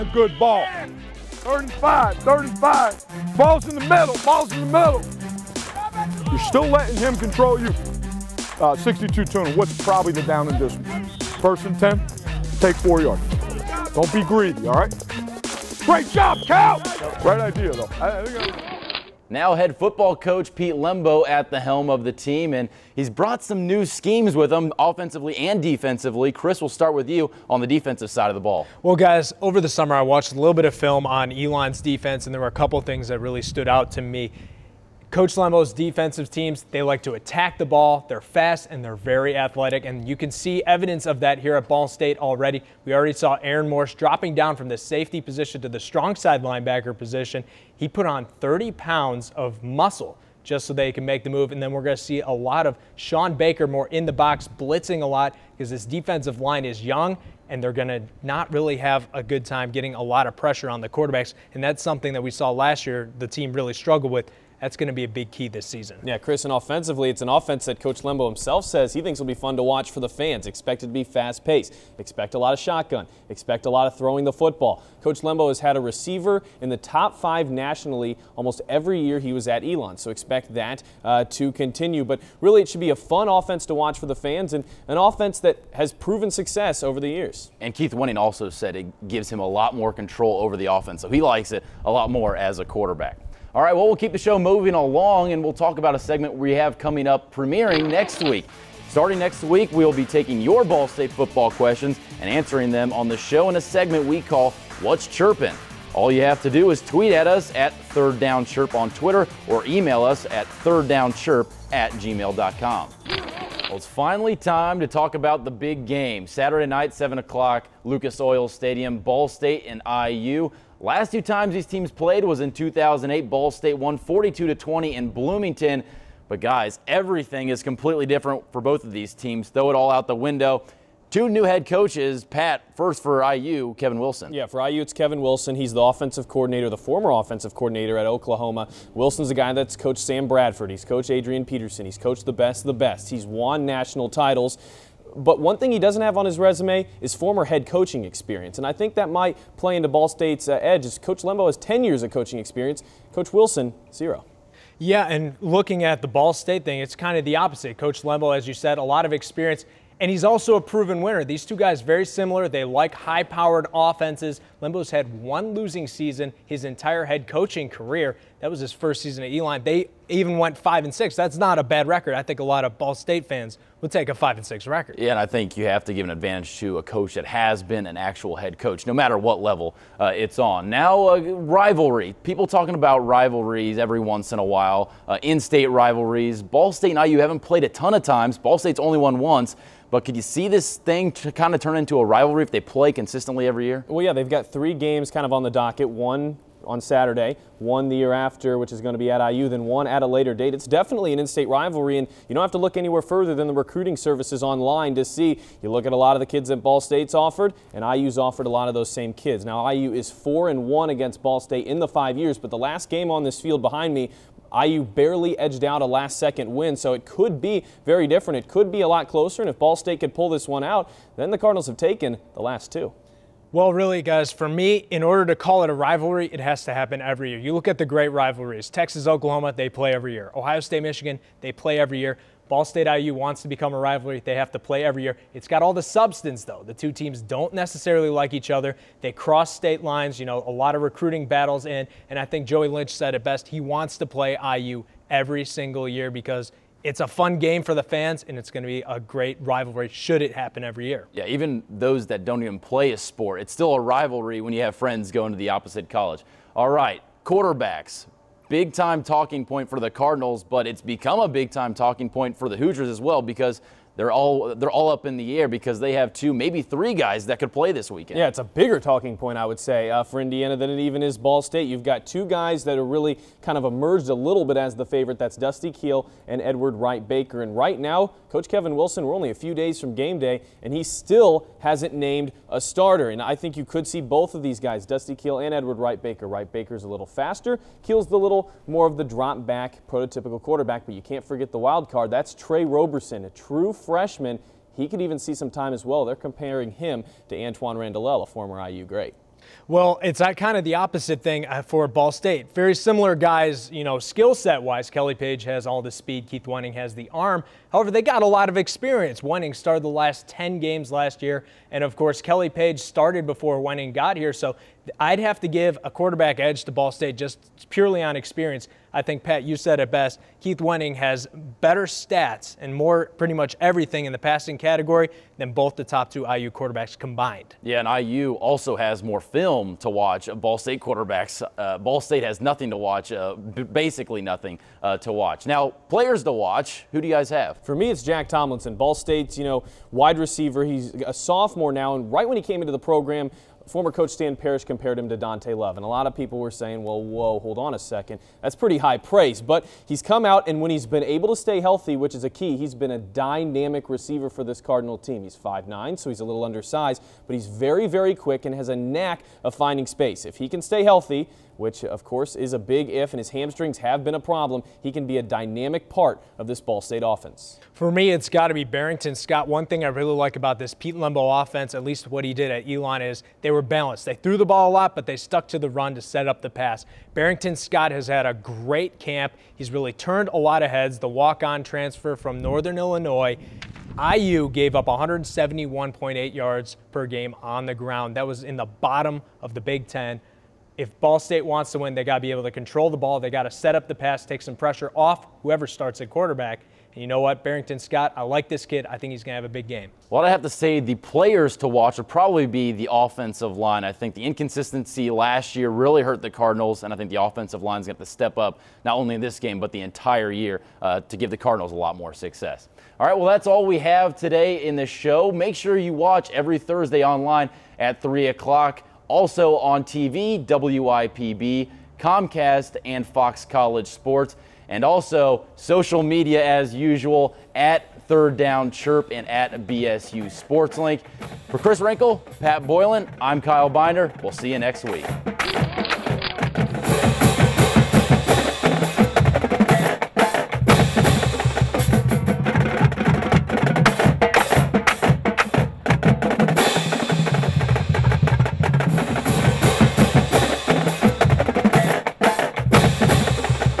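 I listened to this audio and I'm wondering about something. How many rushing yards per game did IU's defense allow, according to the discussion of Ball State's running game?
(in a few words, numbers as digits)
171.8.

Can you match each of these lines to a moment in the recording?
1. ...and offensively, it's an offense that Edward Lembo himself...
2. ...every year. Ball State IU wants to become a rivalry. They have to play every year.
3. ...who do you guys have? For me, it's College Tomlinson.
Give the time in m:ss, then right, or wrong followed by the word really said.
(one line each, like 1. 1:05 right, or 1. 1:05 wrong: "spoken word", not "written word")
1. 1:06 wrong: "Coach", not "Edward"
2. 3:51 right
3. 5:36 wrong: "Jack", not "College".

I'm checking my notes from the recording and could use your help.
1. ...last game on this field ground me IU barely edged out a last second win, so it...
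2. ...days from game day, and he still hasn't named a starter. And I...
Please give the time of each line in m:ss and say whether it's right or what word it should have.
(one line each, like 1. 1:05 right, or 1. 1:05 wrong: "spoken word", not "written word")
1. 3:32 wrong: "behind", not "ground"
2. 4:39 right.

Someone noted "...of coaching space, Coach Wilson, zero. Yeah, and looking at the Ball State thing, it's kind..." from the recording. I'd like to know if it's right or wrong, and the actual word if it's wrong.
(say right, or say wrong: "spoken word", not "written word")
wrong: "experience", not "space".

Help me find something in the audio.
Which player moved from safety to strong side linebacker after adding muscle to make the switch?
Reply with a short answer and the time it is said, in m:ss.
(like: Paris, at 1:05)
Aaron Morse, at 0:43.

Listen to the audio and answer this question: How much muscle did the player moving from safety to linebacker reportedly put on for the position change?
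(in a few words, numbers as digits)
30 pounds.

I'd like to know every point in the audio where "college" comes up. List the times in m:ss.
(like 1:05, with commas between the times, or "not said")
4:15, 7:03.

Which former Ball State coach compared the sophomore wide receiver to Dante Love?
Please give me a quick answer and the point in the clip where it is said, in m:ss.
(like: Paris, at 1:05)
Stan Parrish, at 5:44.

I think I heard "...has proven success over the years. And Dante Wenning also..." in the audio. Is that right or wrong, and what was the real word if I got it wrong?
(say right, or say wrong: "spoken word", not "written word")
wrong: "Keith", not "Dante".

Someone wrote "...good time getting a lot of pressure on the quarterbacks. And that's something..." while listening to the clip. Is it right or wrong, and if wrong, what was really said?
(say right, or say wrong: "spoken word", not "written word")
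right.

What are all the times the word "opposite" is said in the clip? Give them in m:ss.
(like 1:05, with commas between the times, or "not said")
2:37, 4:15, 5:00.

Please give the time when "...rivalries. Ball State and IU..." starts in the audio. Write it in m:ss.
3:05.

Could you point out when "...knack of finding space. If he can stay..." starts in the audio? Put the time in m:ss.
5:58.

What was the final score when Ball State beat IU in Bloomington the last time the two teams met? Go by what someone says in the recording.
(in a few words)
42 to 20.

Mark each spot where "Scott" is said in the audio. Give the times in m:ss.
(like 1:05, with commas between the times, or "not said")
6:09, 6:17, 6:37.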